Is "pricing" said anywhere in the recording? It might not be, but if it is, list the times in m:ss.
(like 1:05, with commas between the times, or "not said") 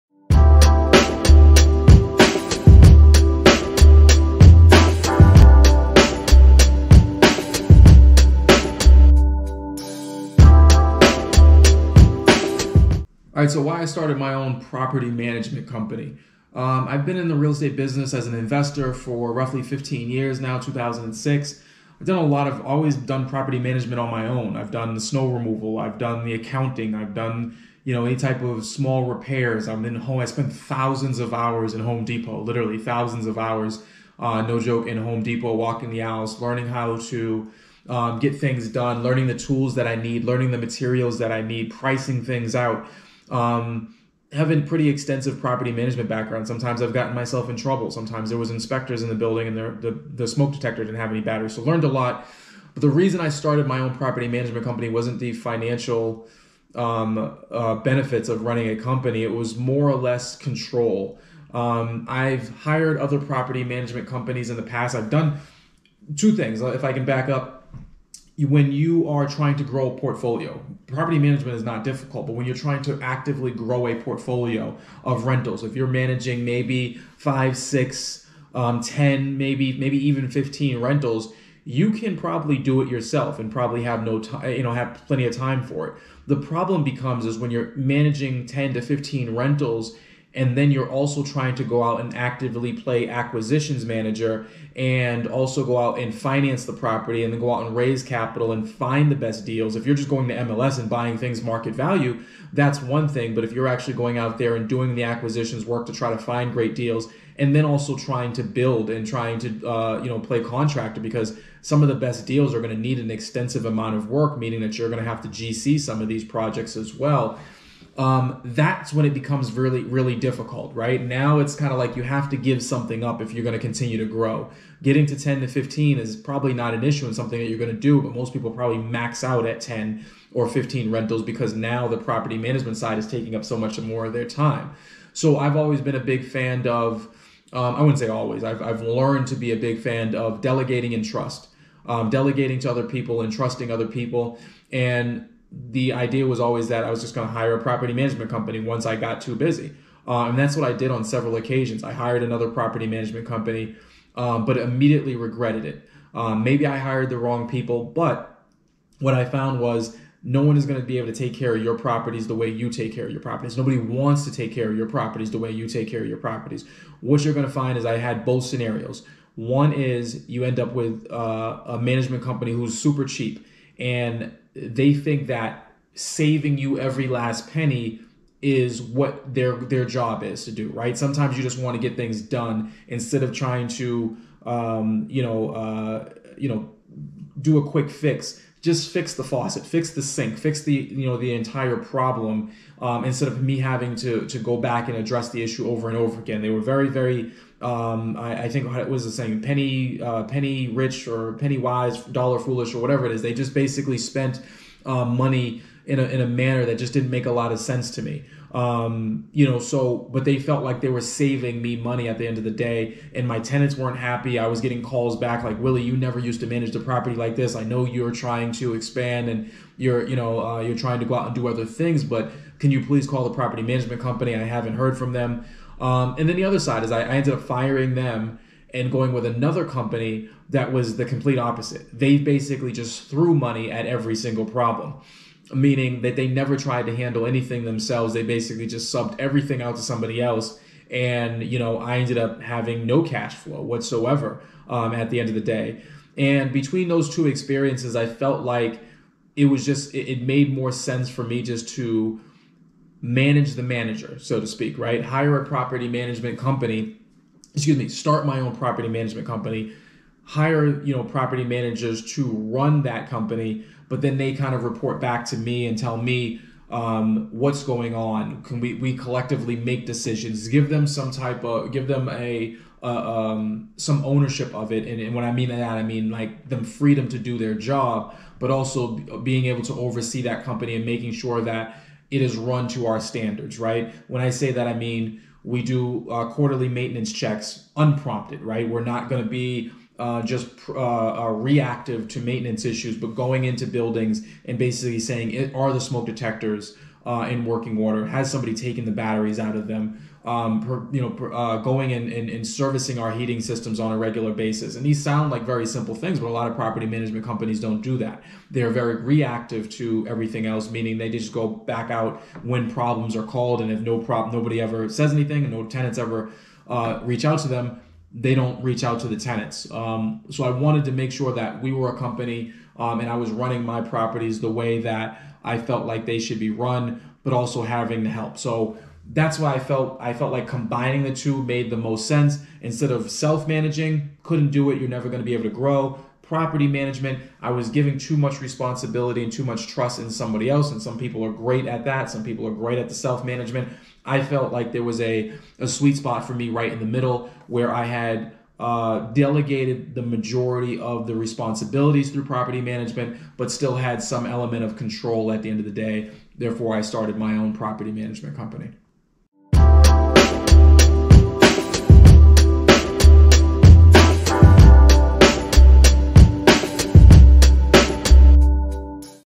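0:41.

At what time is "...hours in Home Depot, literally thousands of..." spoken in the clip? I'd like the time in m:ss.
0:31.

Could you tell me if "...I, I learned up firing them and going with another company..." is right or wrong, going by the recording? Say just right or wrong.
wrong.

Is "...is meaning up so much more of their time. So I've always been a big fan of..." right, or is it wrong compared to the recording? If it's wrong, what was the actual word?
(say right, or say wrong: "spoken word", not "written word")
wrong: "taking", not "meaning".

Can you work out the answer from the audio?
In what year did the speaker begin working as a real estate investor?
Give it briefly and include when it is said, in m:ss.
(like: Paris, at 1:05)
2006, at 0:20.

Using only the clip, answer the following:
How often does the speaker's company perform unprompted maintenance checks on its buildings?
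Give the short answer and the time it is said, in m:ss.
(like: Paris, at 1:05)
Quarterly, at 4:46.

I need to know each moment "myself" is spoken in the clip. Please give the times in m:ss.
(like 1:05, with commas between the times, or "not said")
0:47.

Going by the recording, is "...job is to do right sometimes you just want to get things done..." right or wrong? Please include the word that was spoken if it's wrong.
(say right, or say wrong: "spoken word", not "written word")
right.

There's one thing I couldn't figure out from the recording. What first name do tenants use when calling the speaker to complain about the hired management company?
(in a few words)
Willie.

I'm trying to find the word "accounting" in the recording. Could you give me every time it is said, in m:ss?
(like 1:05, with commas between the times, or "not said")
0:26.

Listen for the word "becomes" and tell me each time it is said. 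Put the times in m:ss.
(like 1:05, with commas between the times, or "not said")
1:26, 1:59.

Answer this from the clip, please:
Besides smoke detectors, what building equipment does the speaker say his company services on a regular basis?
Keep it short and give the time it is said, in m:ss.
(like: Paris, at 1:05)
Heating systems, at 5:03.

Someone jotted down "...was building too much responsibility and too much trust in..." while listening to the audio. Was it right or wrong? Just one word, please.
wrong.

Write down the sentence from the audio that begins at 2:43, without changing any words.
Nobody wants to take care of your properties the way you take care of your properties.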